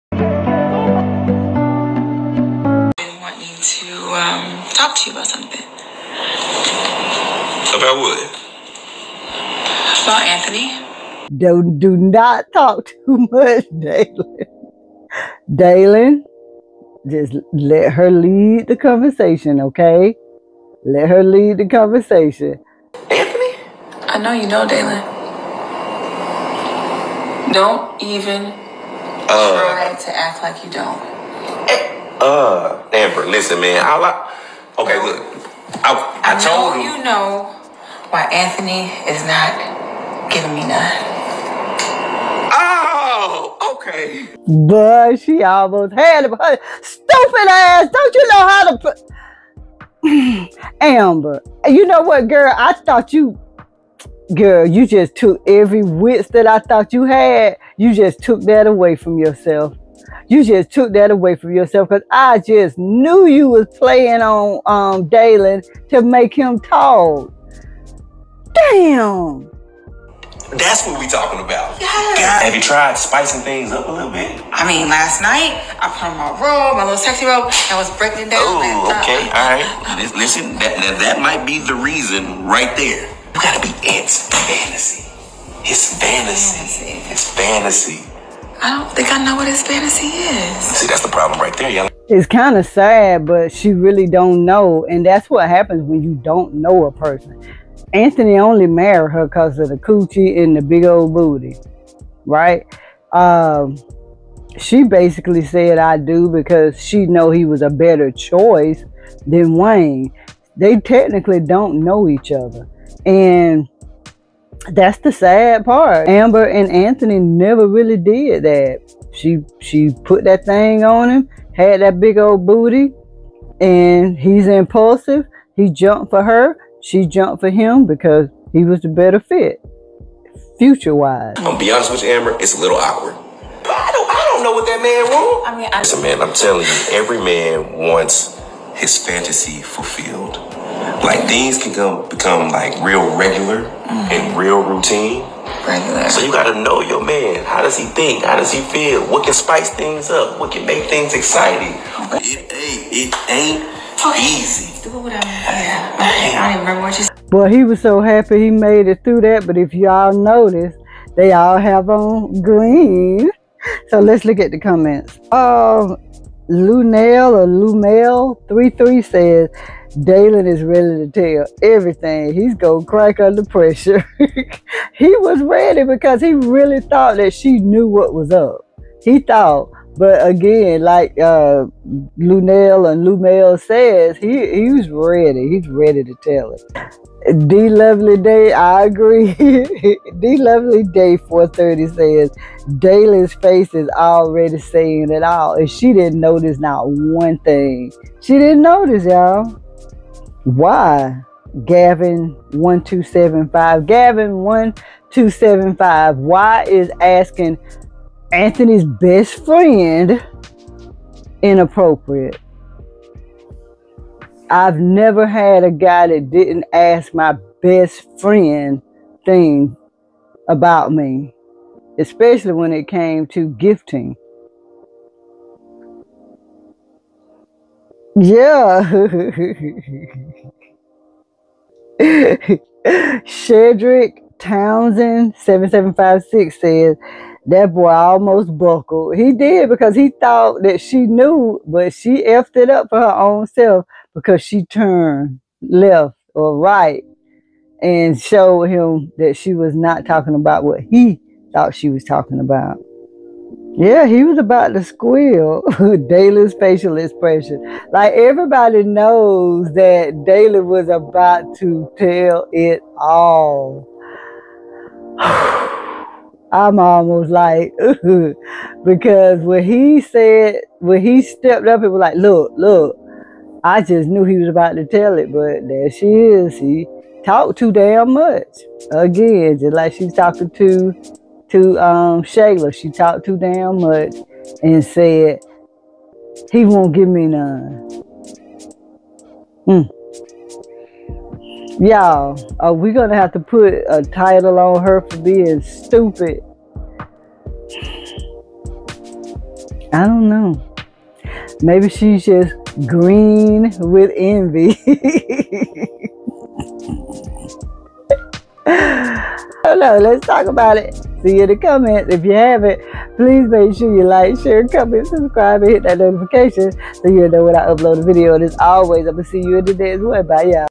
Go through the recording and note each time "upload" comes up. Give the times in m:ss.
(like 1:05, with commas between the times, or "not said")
5:17.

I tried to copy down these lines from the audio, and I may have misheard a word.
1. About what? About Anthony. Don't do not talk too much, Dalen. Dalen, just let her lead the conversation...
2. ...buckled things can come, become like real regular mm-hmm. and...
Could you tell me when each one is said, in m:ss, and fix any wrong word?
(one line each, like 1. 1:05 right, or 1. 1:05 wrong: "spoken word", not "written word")
1. 0:07 right
2. 2:19 wrong: "fulfilled", not "buckled".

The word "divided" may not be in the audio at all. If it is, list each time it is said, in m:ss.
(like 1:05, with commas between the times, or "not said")
not said.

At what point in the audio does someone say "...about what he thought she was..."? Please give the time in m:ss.
4:10.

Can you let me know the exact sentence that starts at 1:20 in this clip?
Listen, that, that that might be the reason right there.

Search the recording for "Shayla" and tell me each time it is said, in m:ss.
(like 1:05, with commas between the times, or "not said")
4:42.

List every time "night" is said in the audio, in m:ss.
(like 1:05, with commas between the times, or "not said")
1:15.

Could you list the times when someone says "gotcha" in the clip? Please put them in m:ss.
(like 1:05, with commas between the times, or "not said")
not said.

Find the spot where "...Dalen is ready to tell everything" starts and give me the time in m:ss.
2:49.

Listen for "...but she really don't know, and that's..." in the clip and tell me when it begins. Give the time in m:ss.
1:33.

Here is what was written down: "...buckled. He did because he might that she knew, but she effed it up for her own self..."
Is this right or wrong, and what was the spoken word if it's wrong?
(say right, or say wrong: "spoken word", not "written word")
wrong: "thought", not "might".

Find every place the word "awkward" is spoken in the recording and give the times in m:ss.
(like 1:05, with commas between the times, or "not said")
2:12.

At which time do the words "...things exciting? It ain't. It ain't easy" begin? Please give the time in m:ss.
2:30.